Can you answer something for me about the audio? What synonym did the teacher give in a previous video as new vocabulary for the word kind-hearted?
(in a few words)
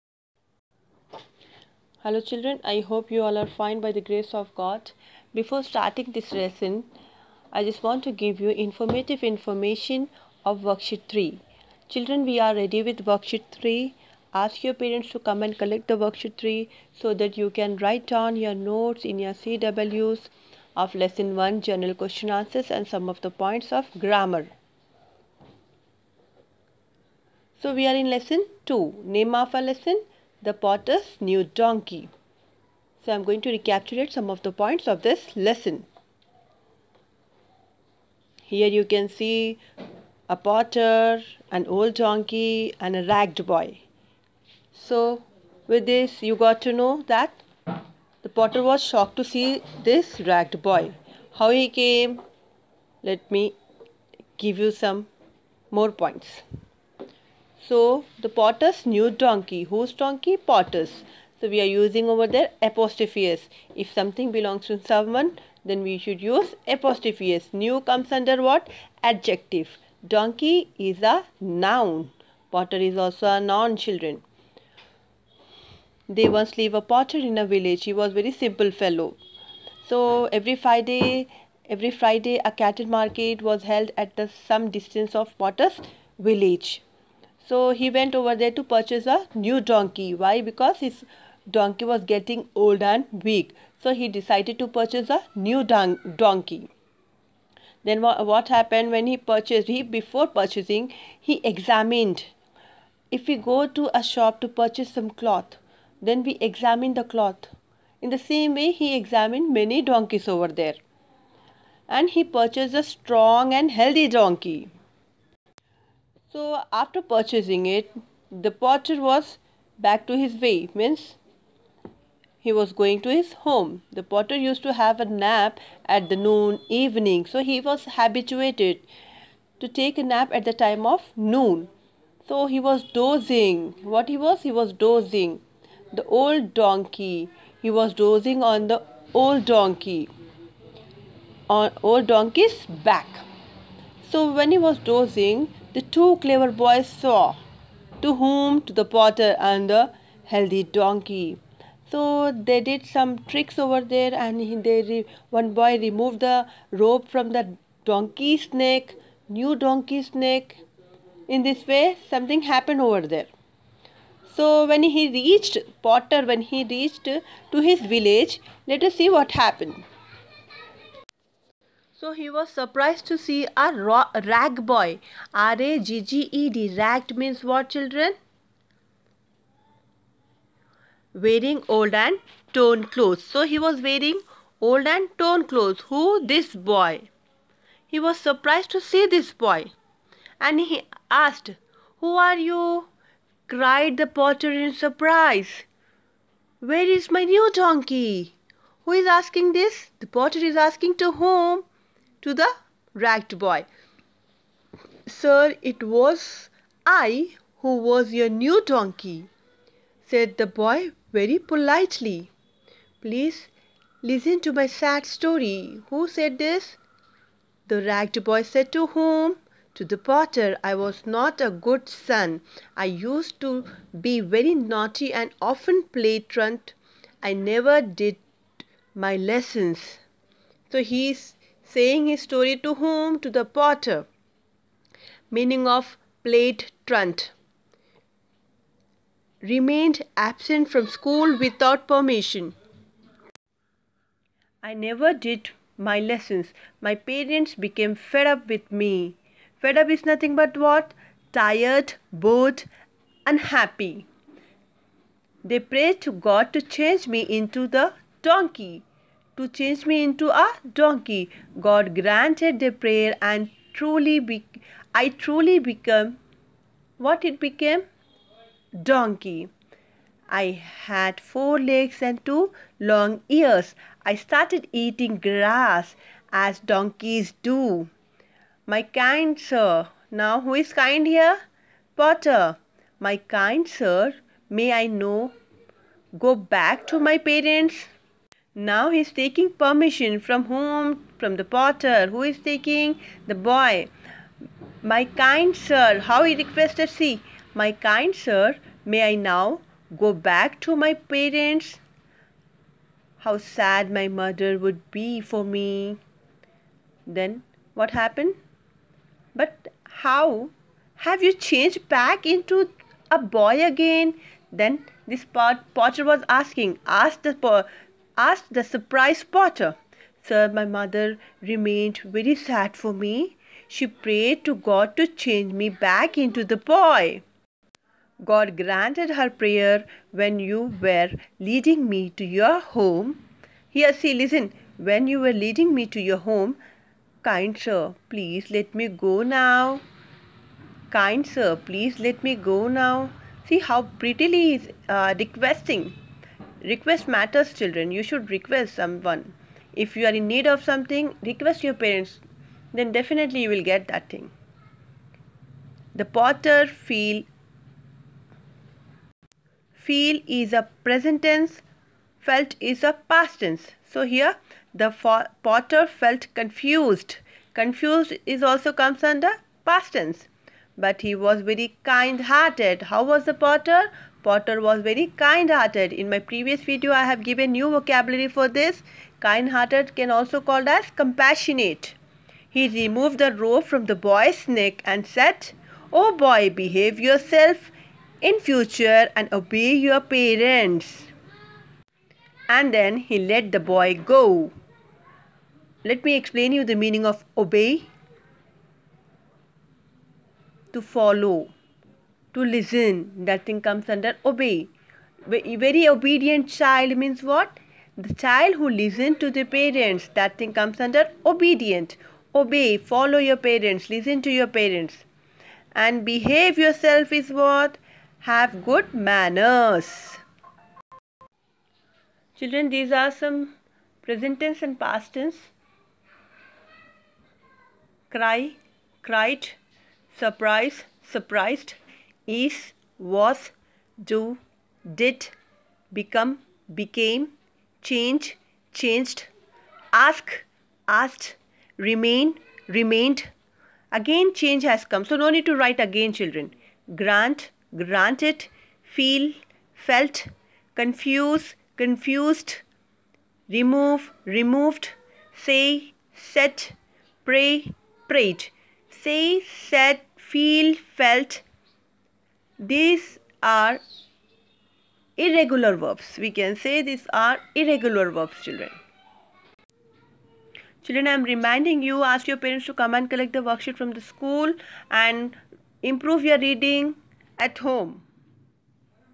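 Compassionate.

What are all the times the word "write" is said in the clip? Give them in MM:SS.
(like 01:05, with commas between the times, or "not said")
00:17, 07:25.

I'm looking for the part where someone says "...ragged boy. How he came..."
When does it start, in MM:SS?
00:50.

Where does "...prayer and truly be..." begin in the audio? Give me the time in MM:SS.
04:22.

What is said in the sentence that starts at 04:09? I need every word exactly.
Fed up is nothing but what?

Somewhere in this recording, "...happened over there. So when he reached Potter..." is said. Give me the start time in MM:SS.
02:42.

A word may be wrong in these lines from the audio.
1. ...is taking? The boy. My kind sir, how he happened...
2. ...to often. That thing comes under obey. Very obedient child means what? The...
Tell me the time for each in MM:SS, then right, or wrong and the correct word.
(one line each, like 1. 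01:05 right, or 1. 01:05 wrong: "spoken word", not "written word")
1. 04:52 wrong: "requested", not "happened"
2. 06:42 wrong: "listen", not "often".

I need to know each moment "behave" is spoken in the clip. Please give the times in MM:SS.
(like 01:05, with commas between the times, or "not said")
06:26, 06:56.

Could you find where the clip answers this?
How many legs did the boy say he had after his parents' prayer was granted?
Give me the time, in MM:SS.
04:31.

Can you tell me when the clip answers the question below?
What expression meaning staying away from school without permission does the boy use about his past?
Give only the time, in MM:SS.
03:45.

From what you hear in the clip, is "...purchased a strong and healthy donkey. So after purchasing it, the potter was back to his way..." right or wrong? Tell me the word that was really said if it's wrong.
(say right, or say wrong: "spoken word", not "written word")
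right.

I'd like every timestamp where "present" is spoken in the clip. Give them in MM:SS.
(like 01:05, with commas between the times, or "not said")
06:00, 07:04.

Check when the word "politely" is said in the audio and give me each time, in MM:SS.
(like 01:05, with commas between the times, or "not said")
03:31.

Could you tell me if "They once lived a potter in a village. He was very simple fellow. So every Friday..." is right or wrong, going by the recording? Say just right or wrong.
right.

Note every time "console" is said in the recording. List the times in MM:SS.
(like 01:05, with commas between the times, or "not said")
not said.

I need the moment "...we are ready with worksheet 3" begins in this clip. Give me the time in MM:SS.
00:12.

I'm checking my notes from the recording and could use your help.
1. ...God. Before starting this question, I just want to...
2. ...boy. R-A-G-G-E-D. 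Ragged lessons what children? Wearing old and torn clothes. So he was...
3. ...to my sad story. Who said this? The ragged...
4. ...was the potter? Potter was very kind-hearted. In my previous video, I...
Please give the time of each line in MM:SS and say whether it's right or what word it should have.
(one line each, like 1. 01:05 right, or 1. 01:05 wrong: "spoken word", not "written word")
1. 00:04 wrong: "lesson", not "question"
2. 02:54 wrong: "means", not "lessons"
3. 03:34 right
4. 06:13 right.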